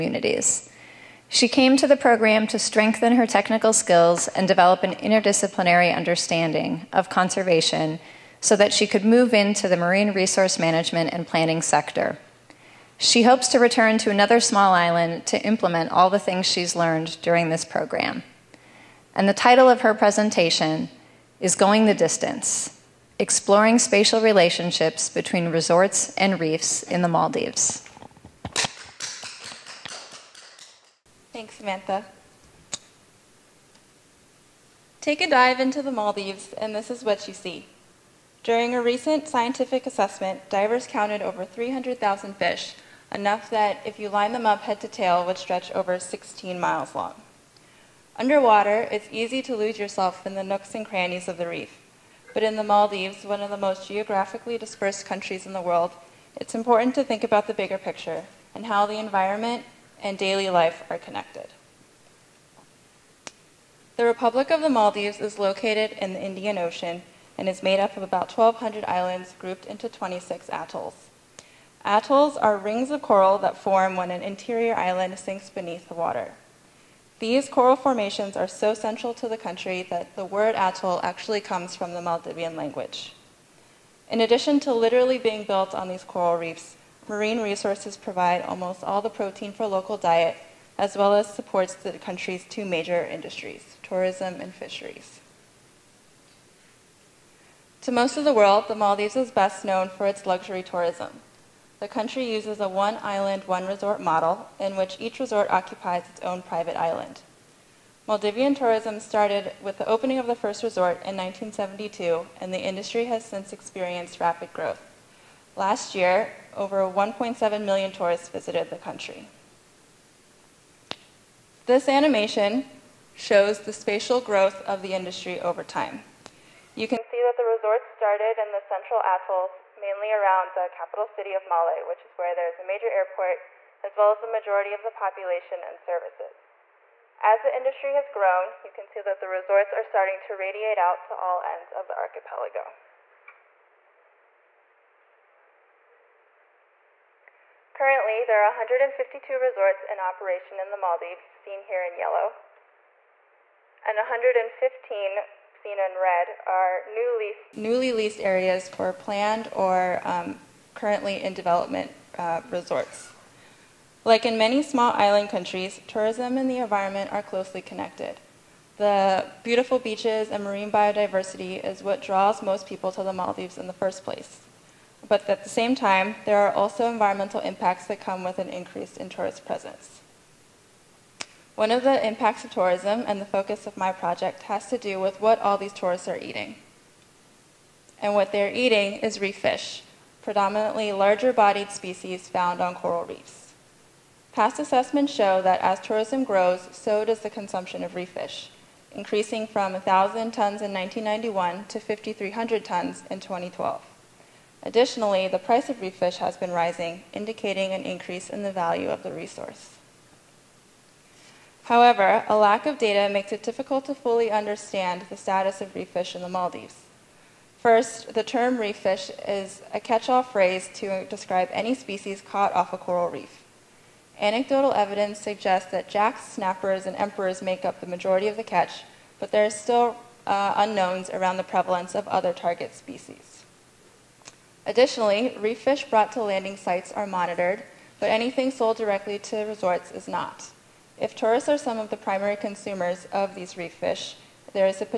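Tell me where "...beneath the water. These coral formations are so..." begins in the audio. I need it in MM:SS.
01:15.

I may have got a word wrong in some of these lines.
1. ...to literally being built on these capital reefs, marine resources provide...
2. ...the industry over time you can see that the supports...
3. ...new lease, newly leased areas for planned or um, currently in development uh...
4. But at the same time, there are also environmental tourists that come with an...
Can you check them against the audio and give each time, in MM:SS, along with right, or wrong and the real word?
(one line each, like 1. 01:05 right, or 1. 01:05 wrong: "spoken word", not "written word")
1. 01:24 wrong: "coral", not "capital"
2. 02:04 wrong: "resorts", not "supports"
3. 02:36 right
4. 02:55 wrong: "impacts", not "tourists".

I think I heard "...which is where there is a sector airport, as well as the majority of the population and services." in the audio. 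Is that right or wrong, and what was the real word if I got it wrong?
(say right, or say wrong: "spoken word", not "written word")
wrong: "major", not "sector".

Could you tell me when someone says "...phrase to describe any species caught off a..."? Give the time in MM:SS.
03:40.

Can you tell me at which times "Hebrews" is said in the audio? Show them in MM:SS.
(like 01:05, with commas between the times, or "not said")
not said.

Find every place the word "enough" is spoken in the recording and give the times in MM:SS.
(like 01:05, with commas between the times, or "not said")
00:43.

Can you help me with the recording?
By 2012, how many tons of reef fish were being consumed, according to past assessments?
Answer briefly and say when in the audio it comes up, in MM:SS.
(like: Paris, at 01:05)
5,300 tons, at 03:21.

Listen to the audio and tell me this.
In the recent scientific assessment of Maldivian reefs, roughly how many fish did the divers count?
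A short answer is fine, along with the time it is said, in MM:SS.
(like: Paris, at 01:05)
300,000, at 00:41.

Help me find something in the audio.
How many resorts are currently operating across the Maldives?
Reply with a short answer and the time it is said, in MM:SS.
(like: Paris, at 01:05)
152, at 02:28.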